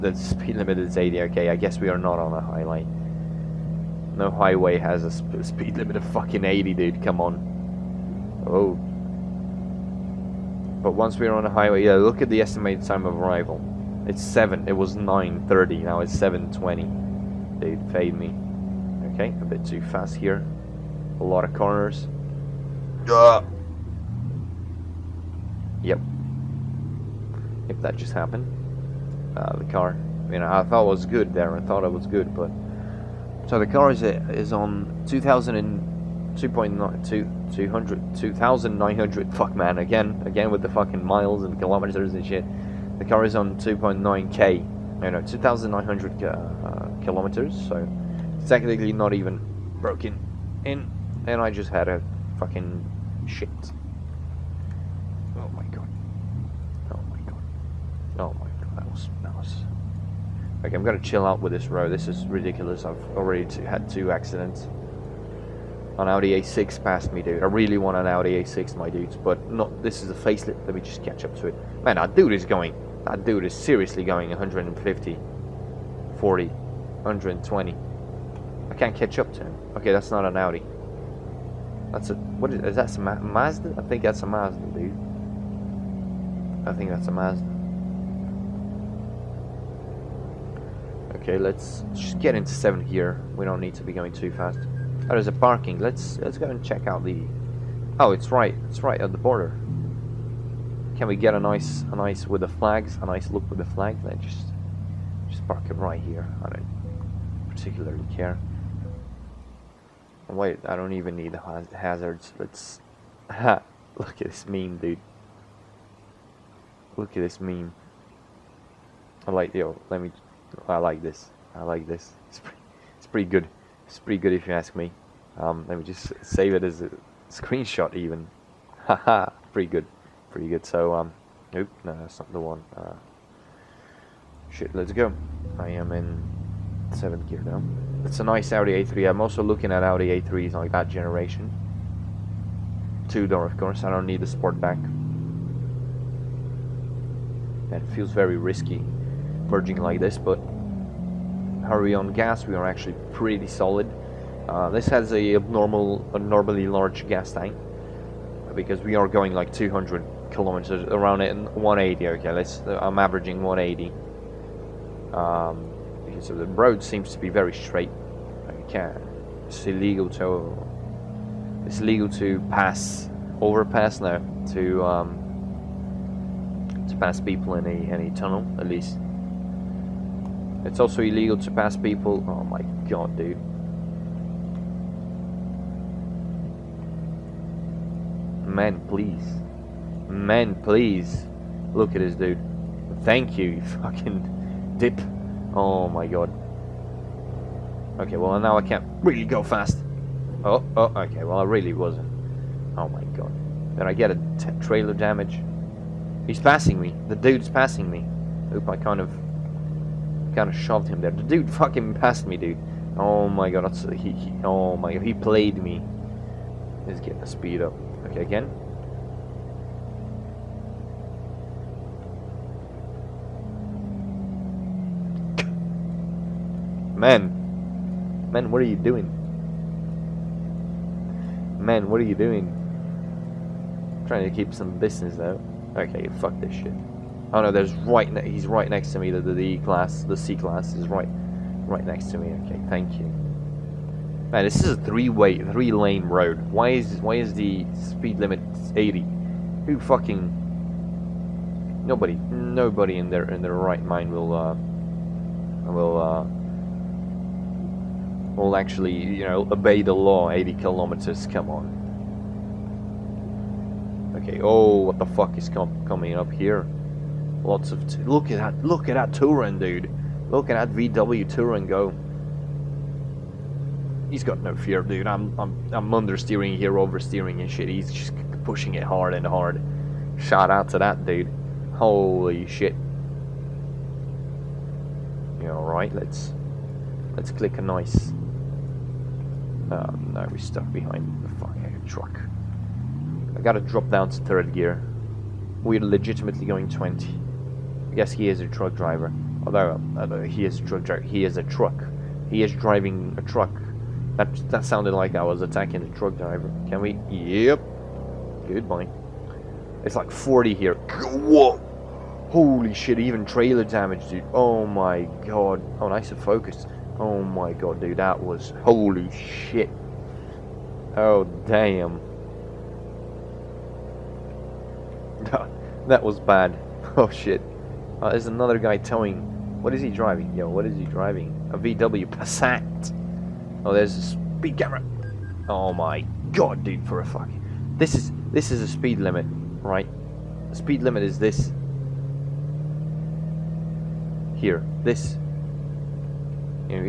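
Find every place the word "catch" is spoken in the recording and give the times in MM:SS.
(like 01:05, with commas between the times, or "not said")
01:11, 01:18.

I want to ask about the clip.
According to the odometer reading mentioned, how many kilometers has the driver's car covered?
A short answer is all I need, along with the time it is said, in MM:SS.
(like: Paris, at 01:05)
2900, at 00:45.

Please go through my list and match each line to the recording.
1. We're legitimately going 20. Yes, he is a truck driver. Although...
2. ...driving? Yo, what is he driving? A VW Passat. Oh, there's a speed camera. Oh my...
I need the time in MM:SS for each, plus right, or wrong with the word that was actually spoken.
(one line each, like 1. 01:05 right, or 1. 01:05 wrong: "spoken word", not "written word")
1. 04:55 right
2. 05:29 right.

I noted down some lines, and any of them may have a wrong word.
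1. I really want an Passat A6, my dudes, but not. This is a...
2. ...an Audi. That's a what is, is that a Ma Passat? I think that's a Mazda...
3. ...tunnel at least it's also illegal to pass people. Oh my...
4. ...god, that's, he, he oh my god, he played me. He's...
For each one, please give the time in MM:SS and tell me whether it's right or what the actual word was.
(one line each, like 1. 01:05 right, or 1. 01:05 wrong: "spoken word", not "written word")
1. 01:07 wrong: "Audi", not "Passat"
2. 01:20 wrong: "Mazda", not "Passat"
3. 02:58 right
4. 03:33 right.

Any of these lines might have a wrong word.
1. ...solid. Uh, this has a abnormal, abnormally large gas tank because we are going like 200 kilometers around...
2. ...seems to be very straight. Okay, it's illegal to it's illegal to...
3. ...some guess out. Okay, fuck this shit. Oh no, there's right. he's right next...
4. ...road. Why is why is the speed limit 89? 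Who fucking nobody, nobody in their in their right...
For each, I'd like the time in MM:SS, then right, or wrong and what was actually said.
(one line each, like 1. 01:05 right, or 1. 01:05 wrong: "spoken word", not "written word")
1. 02:33 right
2. 02:46 right
3. 03:54 wrong: "business", not "guess"
4. 04:06 wrong: "80", not "89".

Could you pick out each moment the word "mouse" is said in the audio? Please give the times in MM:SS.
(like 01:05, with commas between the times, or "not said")
not said.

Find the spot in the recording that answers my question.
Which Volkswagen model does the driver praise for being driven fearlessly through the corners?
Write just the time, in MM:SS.
04:30.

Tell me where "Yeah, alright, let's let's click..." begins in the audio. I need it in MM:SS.
04:45.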